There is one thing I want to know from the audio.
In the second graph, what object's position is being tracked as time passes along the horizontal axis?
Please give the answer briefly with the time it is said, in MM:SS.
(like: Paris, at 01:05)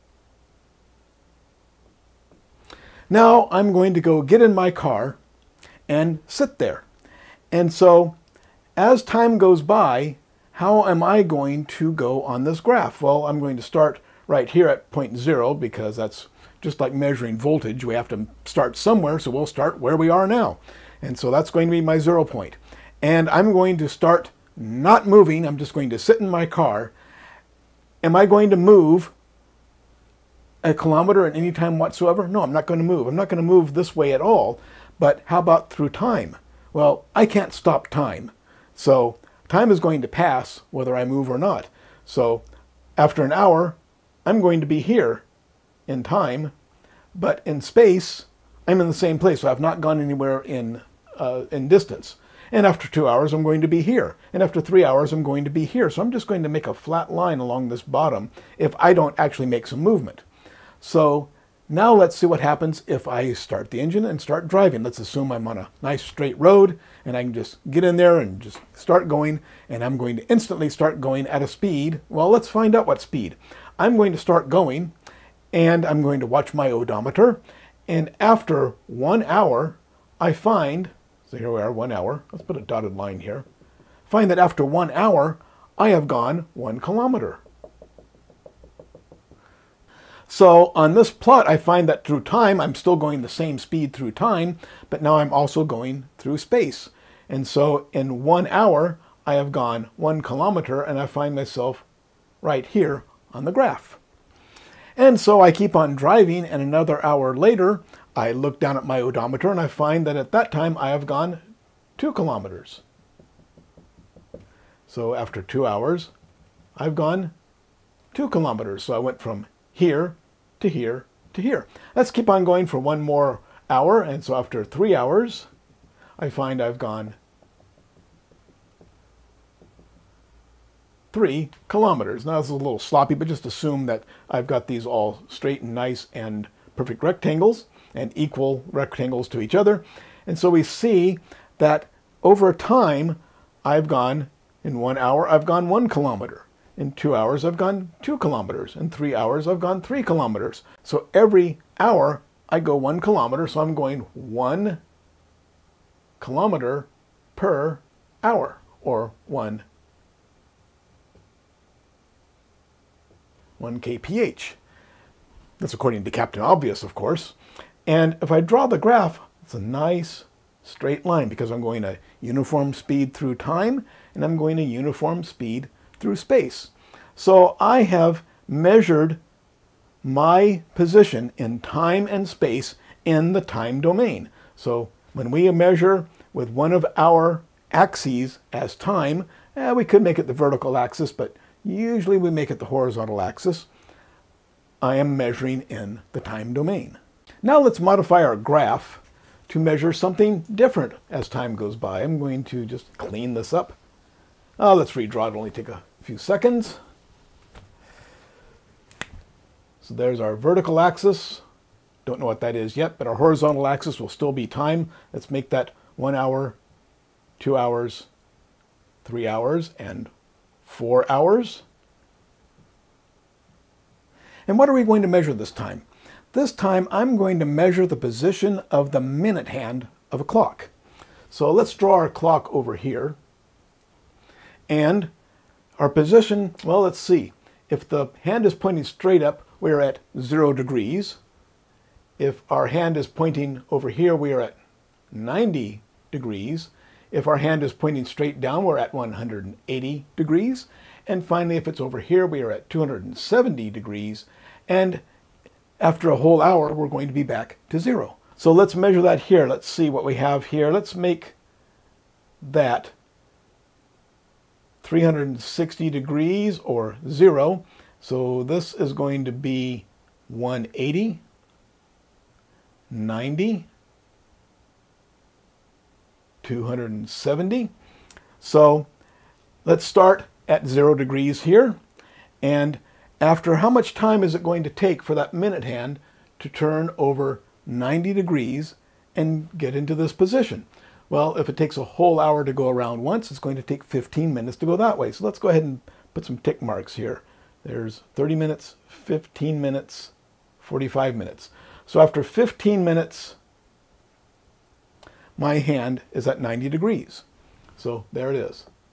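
minute hand of a clock, at 03:49.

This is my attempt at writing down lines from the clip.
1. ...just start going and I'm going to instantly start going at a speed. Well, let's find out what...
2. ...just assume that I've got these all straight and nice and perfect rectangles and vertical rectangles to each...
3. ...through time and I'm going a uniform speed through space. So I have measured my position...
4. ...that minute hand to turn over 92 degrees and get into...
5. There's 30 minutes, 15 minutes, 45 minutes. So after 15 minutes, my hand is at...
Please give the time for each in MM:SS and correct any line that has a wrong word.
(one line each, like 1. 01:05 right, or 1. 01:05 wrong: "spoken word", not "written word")
1. 01:08 right
2. 02:13 wrong: "equal", not "vertical"
3. 02:53 right
4. 04:45 wrong: "90", not "92"
5. 04:57 right.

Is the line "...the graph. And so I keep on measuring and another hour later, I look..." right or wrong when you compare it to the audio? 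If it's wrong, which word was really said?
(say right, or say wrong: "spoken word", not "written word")
wrong: "driving", not "measuring".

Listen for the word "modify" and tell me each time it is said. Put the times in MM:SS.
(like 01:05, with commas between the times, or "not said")
03:17.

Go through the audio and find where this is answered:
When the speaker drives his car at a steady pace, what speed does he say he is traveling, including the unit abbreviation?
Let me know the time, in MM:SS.
02:39.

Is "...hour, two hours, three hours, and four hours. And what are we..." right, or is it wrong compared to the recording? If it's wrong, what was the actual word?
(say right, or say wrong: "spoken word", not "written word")
right.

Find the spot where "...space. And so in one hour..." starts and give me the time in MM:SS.
01:36.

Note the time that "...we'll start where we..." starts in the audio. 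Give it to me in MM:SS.
00:19.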